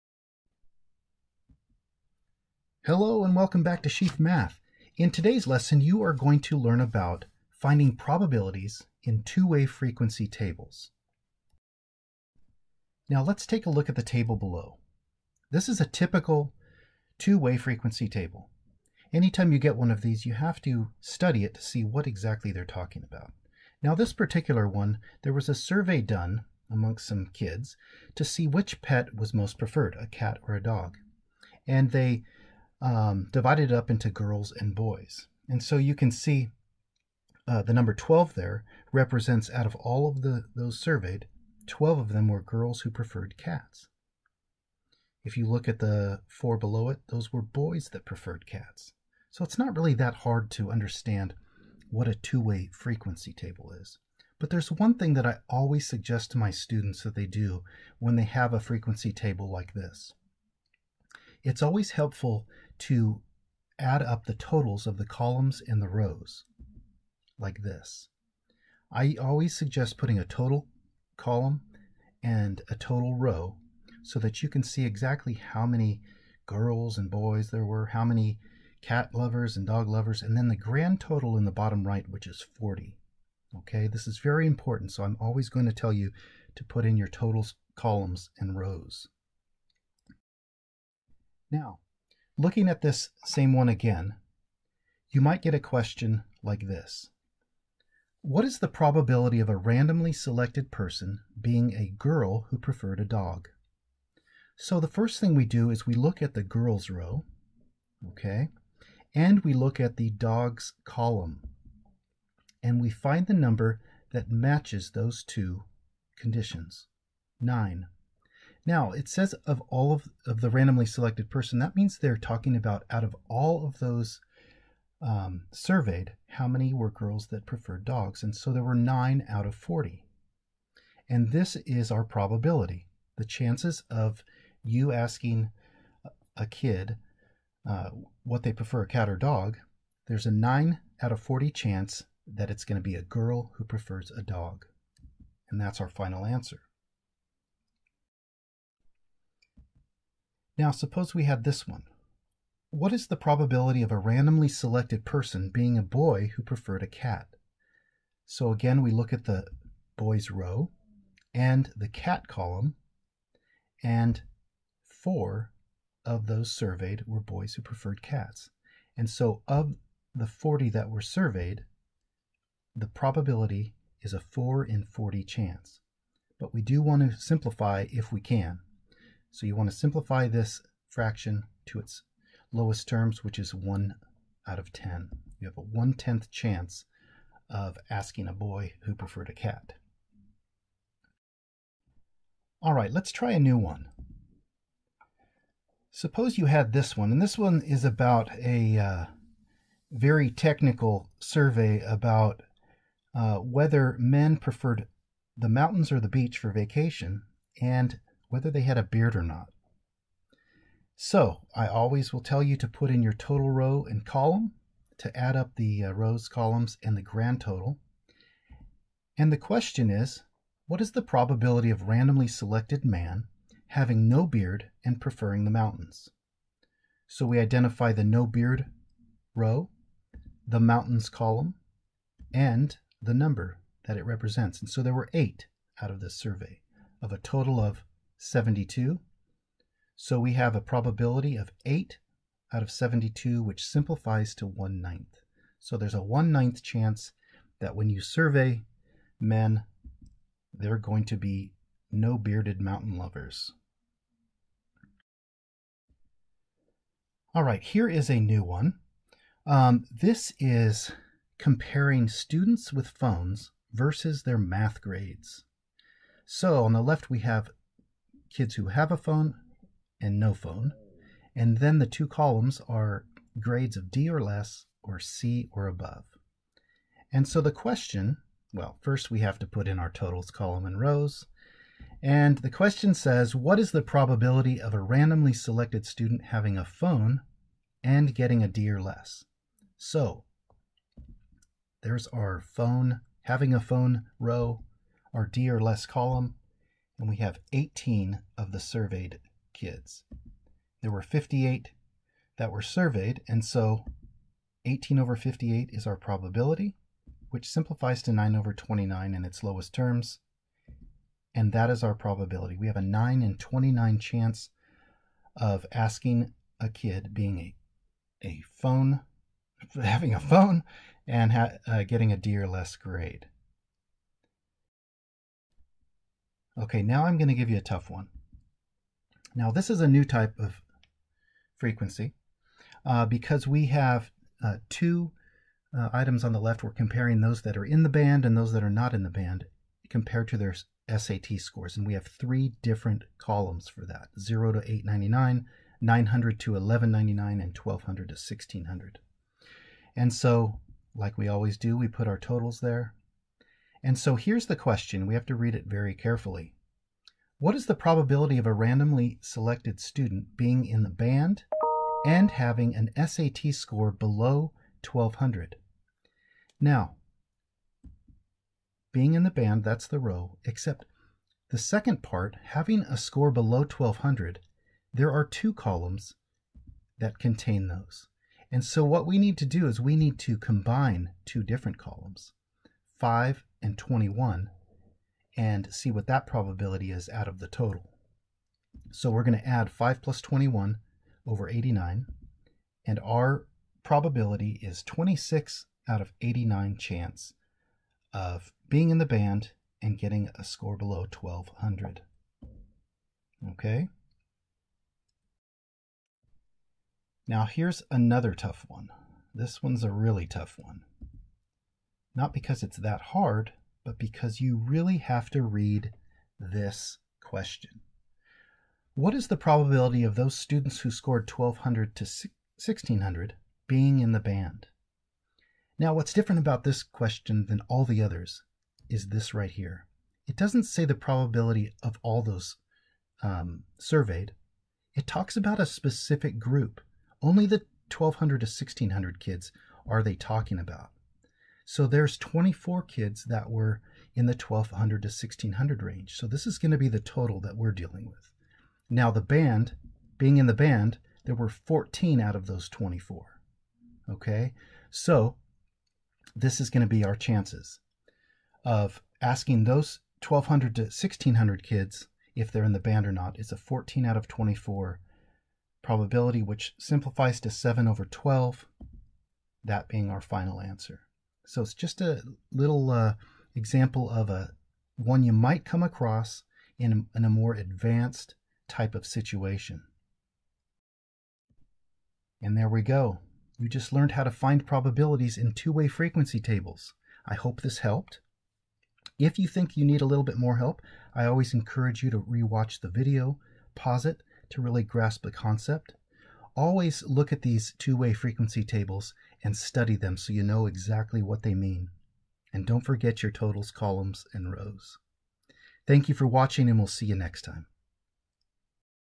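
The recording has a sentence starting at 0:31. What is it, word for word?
And they um, divided up into girls and boys.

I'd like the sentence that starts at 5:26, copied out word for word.
Okay, now I'm going to give you a tough one.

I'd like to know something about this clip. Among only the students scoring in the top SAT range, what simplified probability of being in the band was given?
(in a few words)
7/12.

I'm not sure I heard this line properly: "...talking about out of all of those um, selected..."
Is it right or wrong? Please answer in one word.
wrong.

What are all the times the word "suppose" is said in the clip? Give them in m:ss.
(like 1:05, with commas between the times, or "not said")
2:30, 3:15.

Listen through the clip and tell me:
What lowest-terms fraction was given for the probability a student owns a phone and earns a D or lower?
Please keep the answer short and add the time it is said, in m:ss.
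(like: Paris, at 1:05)
9/29, at 5:08.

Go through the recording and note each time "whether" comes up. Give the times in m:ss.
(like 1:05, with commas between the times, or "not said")
3:23, 3:28.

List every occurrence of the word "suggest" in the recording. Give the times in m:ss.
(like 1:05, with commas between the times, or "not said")
0:55, 1:09.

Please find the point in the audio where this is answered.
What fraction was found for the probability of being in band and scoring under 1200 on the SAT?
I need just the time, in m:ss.
6:34.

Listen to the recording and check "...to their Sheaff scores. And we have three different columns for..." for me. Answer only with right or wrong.
wrong.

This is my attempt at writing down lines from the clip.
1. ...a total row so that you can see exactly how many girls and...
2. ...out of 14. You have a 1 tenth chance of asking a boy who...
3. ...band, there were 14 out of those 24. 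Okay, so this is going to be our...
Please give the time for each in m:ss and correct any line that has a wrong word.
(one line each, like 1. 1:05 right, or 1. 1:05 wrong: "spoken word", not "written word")
1. 1:12 right
2. 3:04 wrong: "10", not "14"
3. 7:30 right.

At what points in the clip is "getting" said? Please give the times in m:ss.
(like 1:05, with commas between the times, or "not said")
4:48, 5:21, 6:39.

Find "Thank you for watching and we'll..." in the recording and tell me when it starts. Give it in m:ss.
8:25.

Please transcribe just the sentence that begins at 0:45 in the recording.
If you look at the four below it, those were boys that preferred cats.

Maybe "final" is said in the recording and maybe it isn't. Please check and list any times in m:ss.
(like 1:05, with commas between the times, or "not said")
2:25, 7:50.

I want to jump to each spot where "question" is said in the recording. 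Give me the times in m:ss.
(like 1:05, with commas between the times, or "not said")
1:35, 3:39, 4:37, 4:42, 5:54, 6:57, 7:06.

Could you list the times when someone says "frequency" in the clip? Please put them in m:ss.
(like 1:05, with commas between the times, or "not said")
0:09, 0:17, 0:52, 0:58, 5:31, 8:05, 8:18.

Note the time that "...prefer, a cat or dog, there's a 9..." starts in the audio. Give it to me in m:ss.
2:18.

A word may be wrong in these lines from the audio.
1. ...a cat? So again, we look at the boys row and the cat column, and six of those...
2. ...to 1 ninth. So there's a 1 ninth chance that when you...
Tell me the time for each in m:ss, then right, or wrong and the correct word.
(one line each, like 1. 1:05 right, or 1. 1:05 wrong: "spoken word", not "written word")
1. 2:36 wrong: "four", not "six"
2. 4:04 right.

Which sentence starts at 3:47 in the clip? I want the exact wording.
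So we identify the no beard row, the mountains column, and the number that it represents.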